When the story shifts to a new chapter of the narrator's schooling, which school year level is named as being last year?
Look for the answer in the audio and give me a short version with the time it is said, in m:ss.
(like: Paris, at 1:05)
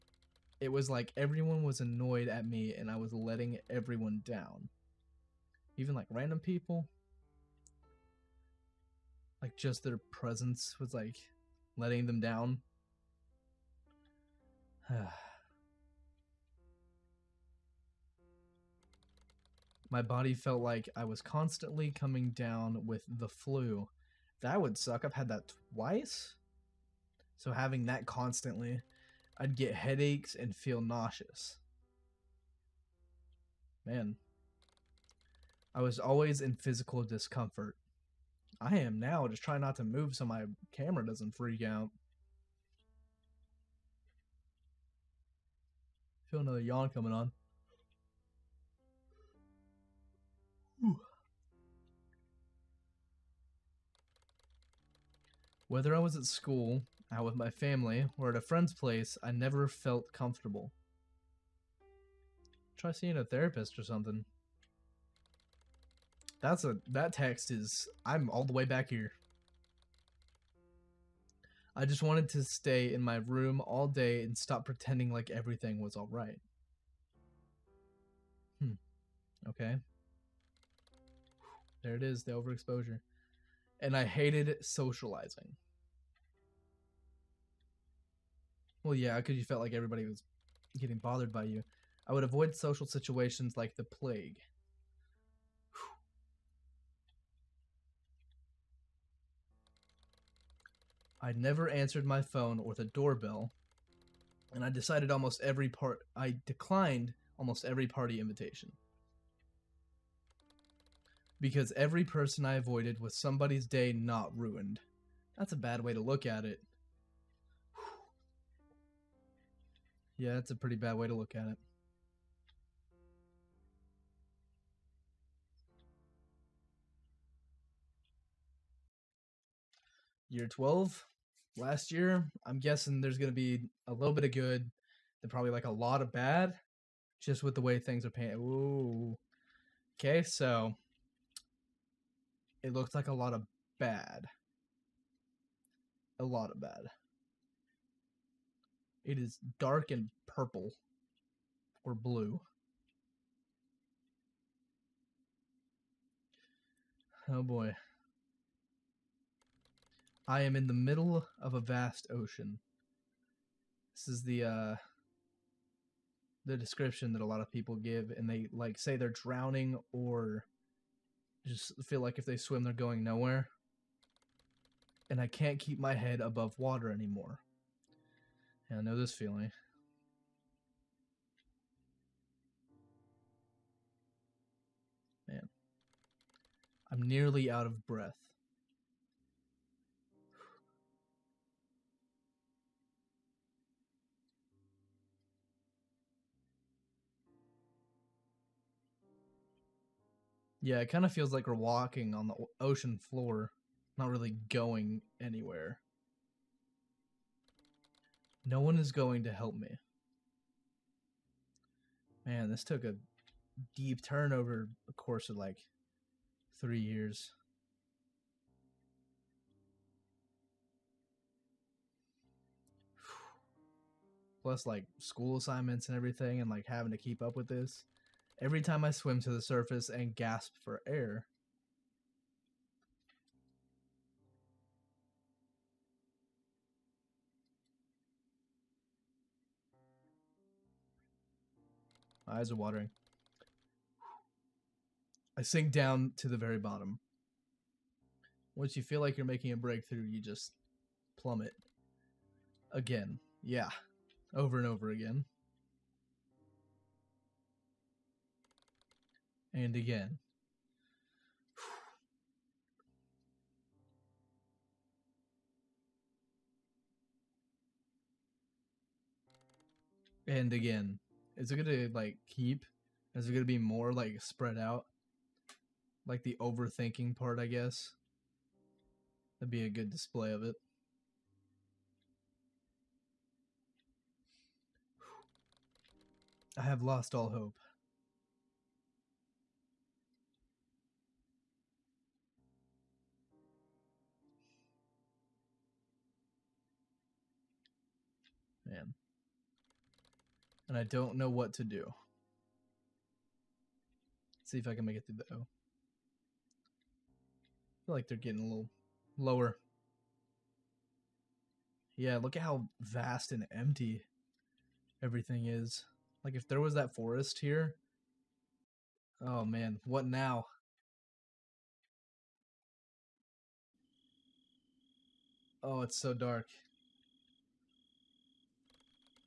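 Year 12, at 2:10.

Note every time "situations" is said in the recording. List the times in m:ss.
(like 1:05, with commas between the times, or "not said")
1:32.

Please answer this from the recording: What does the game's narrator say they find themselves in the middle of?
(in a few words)
a vast ocean.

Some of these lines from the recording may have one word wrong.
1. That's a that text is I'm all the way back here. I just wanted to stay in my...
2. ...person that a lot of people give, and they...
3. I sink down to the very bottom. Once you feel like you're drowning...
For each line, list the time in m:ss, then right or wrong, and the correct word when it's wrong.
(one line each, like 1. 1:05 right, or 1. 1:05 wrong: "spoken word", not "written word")
1. 1:06 right
2. 2:46 wrong: "description", not "person"
3. 4:05 wrong: "making", not "drowning".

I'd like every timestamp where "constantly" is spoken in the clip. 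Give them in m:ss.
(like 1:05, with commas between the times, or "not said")
0:21, 0:28.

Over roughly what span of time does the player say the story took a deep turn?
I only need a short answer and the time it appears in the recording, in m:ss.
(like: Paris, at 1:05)
3 years, at 3:36.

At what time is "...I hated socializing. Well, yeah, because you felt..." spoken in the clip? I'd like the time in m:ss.
1:23.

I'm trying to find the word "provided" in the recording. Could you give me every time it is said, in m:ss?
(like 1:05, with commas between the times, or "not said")
not said.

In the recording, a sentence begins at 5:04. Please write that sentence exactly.
Let's see if I can make it through the O.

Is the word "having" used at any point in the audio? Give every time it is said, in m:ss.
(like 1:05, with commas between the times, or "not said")
0:27, 3:46.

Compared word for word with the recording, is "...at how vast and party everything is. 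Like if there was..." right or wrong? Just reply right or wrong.
wrong.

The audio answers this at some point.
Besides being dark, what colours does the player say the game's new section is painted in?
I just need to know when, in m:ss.
2:30.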